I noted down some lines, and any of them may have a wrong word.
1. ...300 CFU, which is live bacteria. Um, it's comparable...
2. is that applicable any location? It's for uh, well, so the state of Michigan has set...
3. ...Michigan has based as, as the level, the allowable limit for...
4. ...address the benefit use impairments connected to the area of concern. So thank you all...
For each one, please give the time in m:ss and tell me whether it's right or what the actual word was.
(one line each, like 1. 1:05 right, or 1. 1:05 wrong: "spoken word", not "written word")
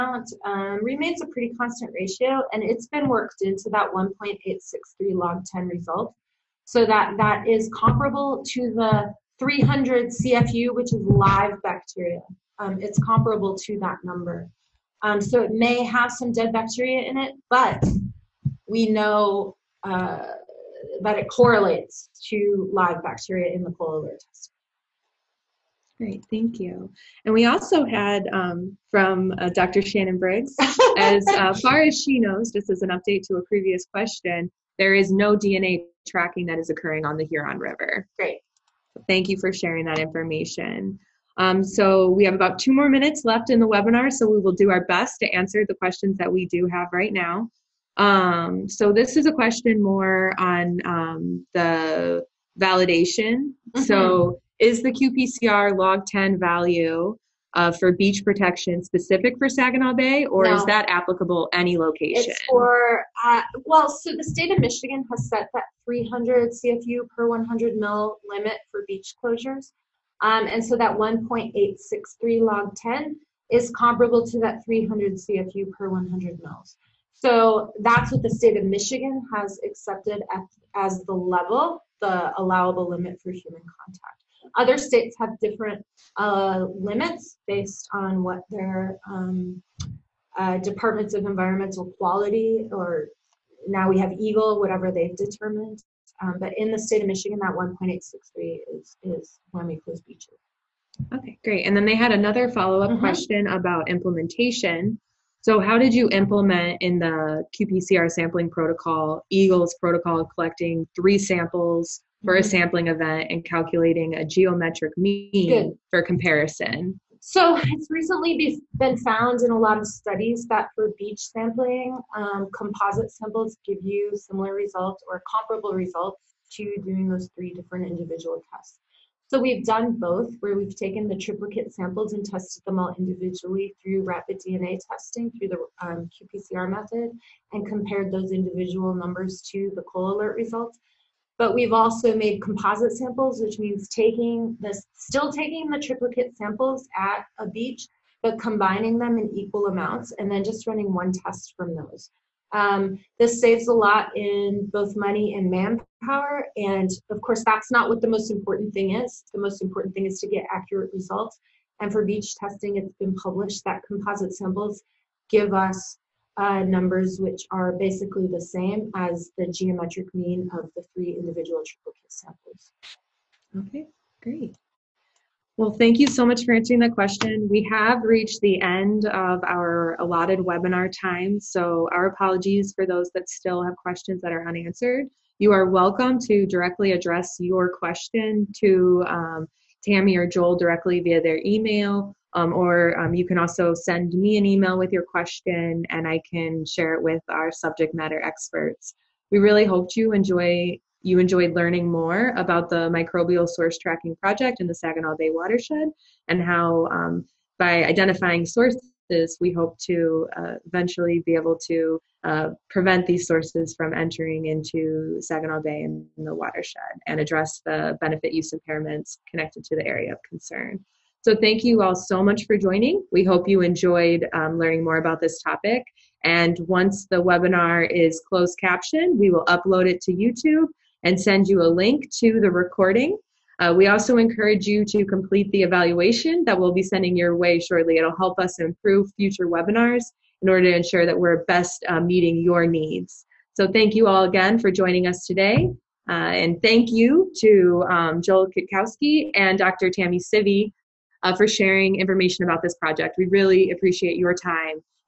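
1. 0:09 right
2. 1:00 right
3. 1:18 wrong: "accepted", not "based"
4. 3:37 right.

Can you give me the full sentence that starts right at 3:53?
Uh, we also encourage you to complete the evaluation that we'll be sending your way shortly.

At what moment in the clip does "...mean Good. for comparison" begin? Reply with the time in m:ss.
1:54.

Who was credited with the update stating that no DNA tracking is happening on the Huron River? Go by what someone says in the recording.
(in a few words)
Dr. Shannon Briggs.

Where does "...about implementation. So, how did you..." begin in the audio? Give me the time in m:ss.
1:43.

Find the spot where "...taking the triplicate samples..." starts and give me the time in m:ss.
2:25.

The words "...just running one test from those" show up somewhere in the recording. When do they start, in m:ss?
2:30.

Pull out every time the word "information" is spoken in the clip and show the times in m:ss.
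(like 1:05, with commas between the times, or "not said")
0:39, 4:11.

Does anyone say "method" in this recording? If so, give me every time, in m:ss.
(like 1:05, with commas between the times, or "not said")
2:16.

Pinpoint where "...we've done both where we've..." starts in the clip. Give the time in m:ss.
2:09.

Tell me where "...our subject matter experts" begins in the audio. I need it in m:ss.
3:17.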